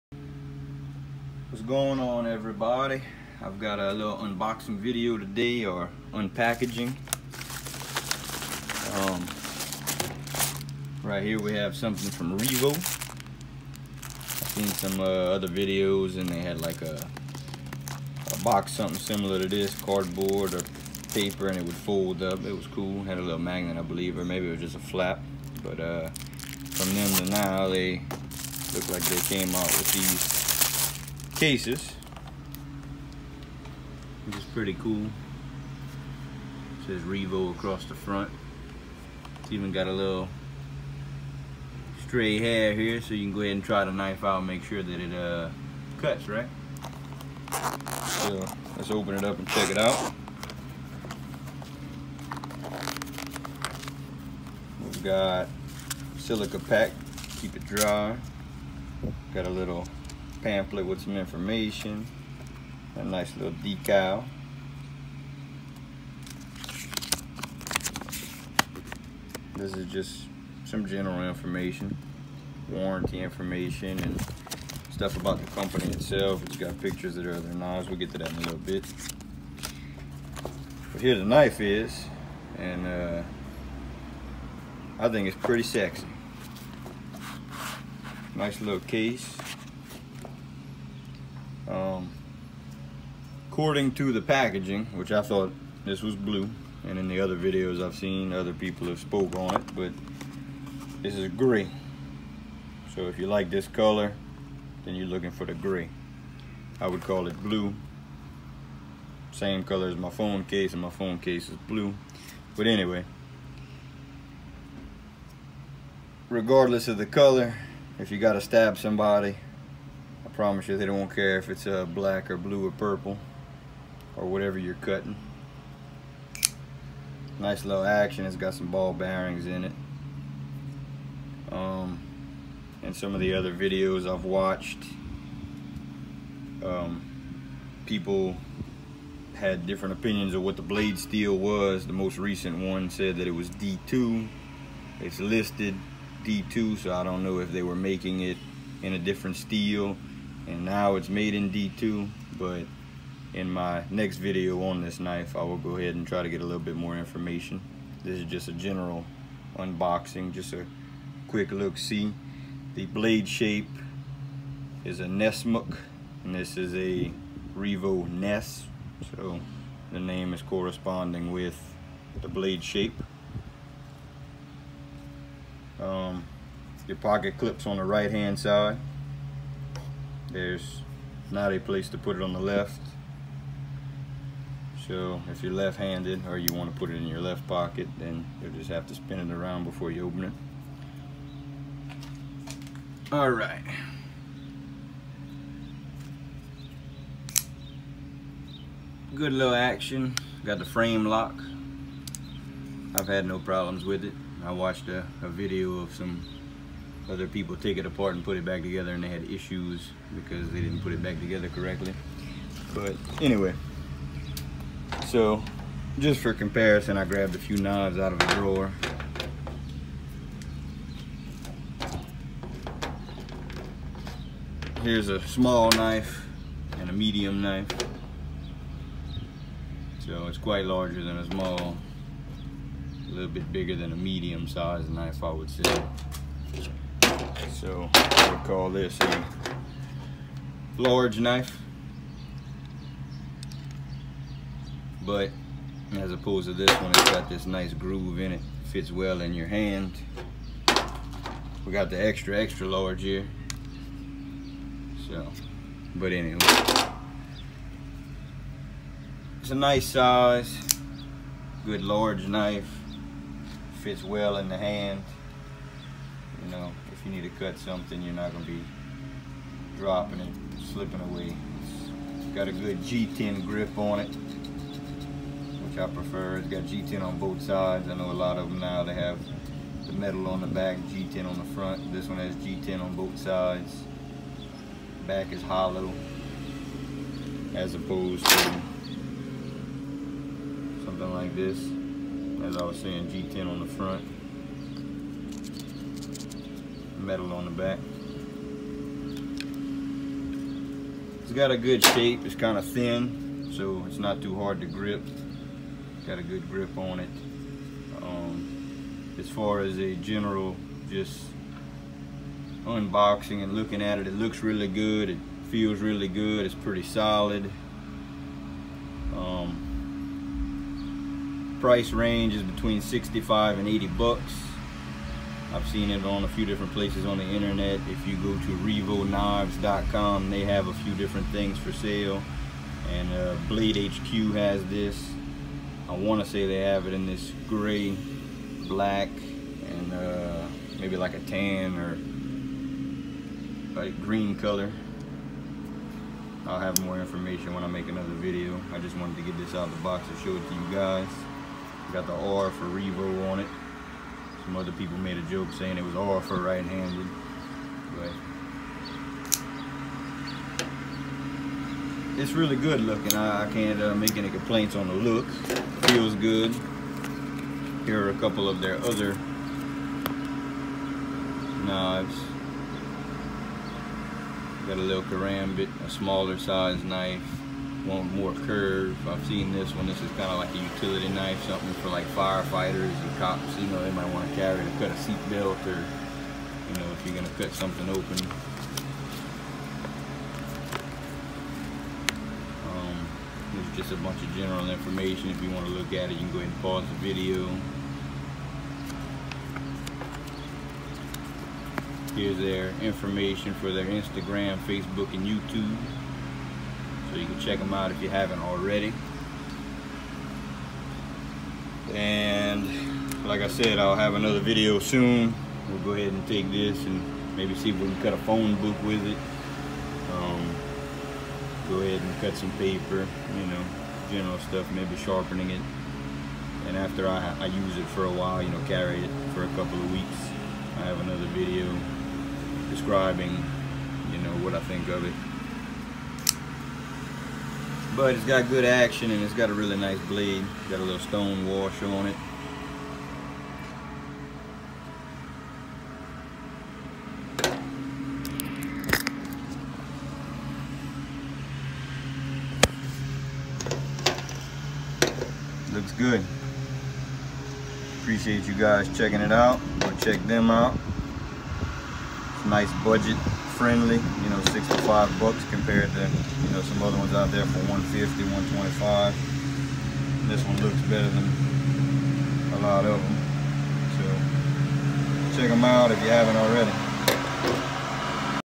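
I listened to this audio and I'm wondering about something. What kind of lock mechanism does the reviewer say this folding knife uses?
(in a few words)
Frame lock.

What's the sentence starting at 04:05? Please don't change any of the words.
But as opposed to this one, it's got this nice groove in it.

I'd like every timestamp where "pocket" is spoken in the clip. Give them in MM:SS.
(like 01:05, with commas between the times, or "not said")
02:56, 03:07.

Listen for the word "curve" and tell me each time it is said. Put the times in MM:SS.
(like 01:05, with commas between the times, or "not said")
06:18.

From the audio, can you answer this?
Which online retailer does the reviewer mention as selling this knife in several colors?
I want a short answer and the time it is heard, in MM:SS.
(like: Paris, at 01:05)
Blade HQ, at 05:33.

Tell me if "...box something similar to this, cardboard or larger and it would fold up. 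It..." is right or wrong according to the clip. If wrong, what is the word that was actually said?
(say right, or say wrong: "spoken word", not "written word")
wrong: "paper", not "larger".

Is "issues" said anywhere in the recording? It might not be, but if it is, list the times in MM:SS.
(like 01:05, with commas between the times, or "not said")
03:29.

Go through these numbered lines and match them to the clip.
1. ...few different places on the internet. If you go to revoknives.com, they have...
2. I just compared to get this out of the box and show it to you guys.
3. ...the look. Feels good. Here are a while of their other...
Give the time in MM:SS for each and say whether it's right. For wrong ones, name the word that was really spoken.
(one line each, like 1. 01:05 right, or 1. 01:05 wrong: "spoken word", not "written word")
1. 05:26 right
2. 05:48 wrong: "wanted", not "compared"
3. 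06:04 wrong: "couple", not "while".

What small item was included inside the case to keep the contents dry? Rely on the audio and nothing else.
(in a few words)
Silica pack.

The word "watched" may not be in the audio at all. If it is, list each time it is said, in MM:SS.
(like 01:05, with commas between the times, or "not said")
02:14, 03:24.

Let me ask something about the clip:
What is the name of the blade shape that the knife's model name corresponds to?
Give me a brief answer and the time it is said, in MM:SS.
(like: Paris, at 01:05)
Nesmuk, at 02:45.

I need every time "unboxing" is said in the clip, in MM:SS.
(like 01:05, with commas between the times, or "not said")
00:04, 02:39, 05:12.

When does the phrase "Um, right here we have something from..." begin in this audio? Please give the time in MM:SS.
00:08.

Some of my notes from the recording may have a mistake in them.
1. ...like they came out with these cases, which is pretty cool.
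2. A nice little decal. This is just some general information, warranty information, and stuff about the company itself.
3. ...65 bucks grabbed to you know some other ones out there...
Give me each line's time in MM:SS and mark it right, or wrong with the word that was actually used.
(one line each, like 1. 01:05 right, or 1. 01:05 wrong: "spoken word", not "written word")
1. 00:28 right
2. 01:02 right
3. 07:44 wrong: "compared", not "grabbed".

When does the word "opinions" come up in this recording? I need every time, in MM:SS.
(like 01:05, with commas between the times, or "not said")
02:19.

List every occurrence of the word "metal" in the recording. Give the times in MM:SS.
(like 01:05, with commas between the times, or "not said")
04:39, 04:57.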